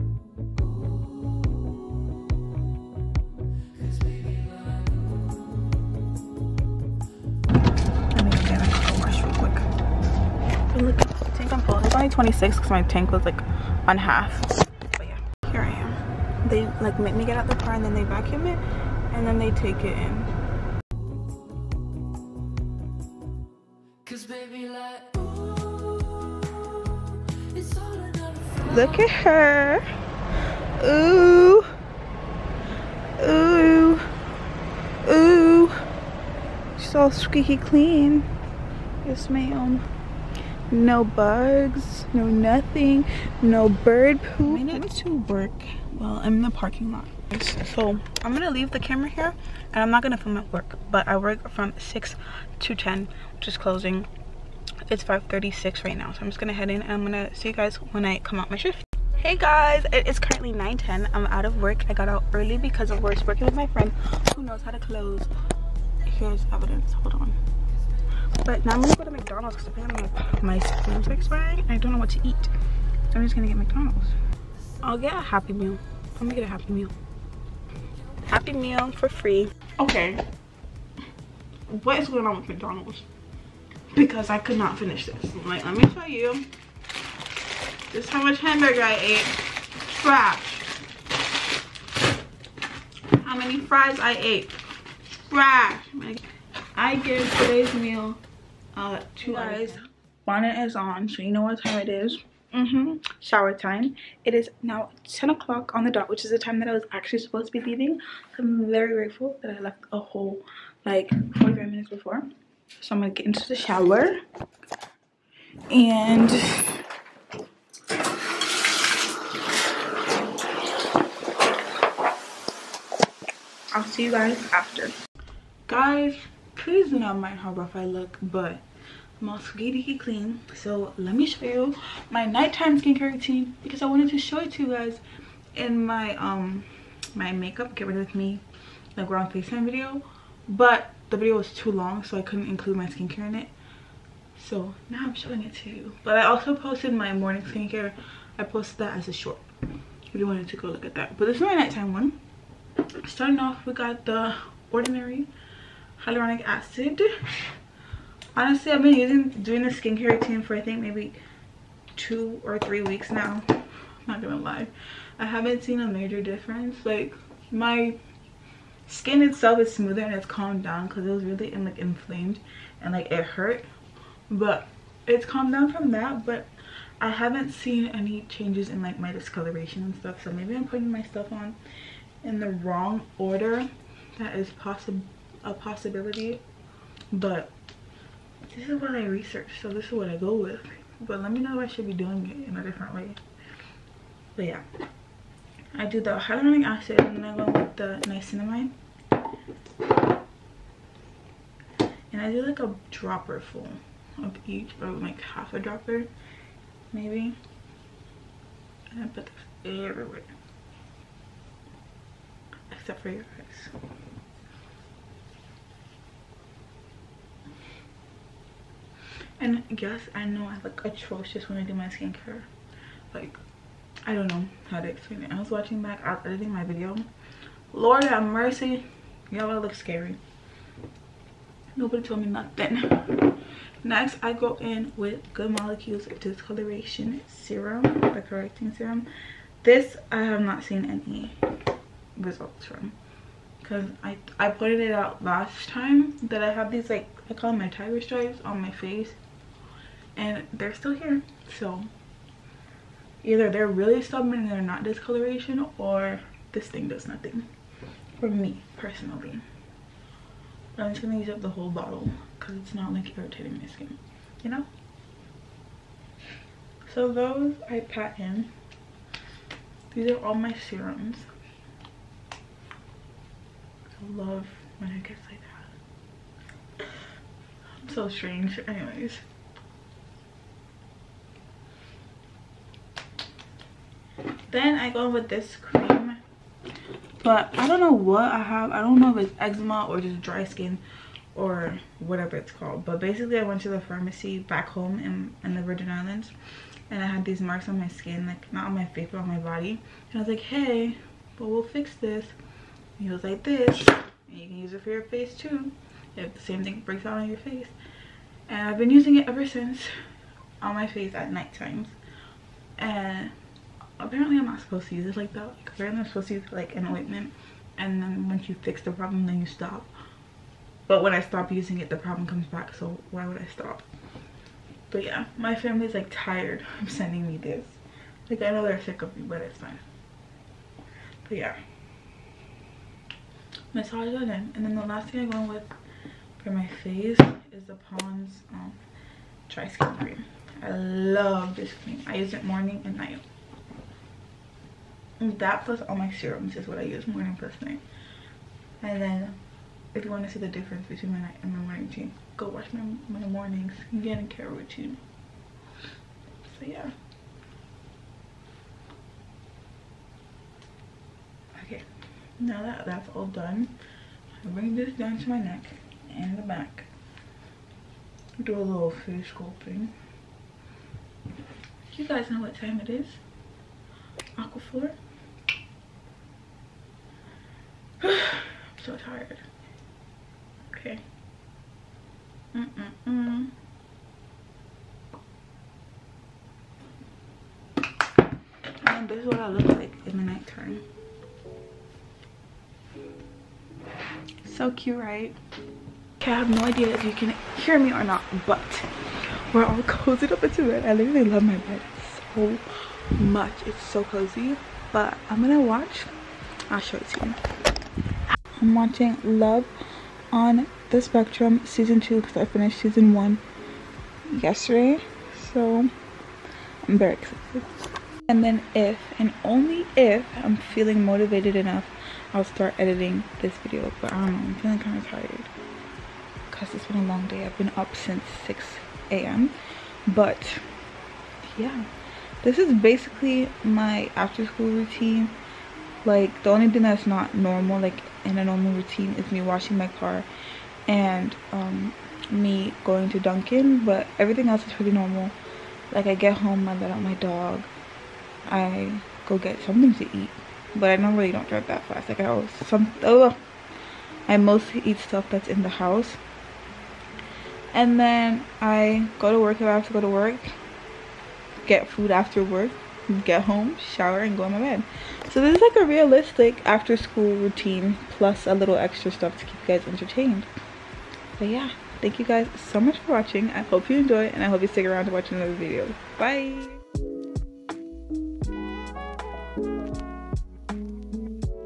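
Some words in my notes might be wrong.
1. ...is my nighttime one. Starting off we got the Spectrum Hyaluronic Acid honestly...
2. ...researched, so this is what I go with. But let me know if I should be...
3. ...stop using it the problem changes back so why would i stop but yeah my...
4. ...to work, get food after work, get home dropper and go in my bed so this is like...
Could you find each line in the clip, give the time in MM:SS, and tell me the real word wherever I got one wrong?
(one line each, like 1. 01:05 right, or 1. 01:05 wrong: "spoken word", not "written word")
1. 02:31 wrong: "Ordinary", not "Spectrum"
2. 03:09 right
3. 05:21 wrong: "comes", not "changes"
4. 07:40 wrong: "shower", not "dropper".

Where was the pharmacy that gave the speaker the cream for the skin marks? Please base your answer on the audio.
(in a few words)
Virgin Islands.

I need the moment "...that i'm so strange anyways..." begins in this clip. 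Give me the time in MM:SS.
04:36.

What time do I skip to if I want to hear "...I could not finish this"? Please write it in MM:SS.
01:24.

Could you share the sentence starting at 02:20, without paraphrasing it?
But the video was too long so I couldn't include my skincare in it.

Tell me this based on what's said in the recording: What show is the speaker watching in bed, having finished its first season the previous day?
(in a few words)
Love on the Spectrum.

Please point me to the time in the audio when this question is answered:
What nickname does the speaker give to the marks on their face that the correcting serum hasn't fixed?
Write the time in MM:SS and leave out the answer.
04:07.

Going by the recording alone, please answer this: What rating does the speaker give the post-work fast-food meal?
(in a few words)
two eyes.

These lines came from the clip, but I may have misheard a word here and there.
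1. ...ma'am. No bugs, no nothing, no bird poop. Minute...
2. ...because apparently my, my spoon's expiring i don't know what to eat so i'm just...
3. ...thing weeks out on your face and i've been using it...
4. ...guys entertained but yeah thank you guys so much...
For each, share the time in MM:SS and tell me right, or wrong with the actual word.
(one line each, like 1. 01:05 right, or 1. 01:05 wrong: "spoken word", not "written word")
1. 00:39 right
2. 01:09 right
3. 05:06 wrong: "breaks", not "weeks"
4. 07:49 right.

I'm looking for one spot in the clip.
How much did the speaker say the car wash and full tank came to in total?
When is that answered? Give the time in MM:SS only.
00:12.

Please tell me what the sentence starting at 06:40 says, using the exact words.
I literally love my bed so much.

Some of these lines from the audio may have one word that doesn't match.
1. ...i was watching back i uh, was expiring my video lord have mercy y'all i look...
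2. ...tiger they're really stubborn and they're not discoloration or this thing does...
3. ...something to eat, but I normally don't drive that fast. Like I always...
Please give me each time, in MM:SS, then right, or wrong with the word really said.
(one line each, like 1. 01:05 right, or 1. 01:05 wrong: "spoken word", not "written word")
1. 03:45 wrong: "editing", not "expiring"
2. 04:13 wrong: "either", not "tiger"
3. 07:29 right.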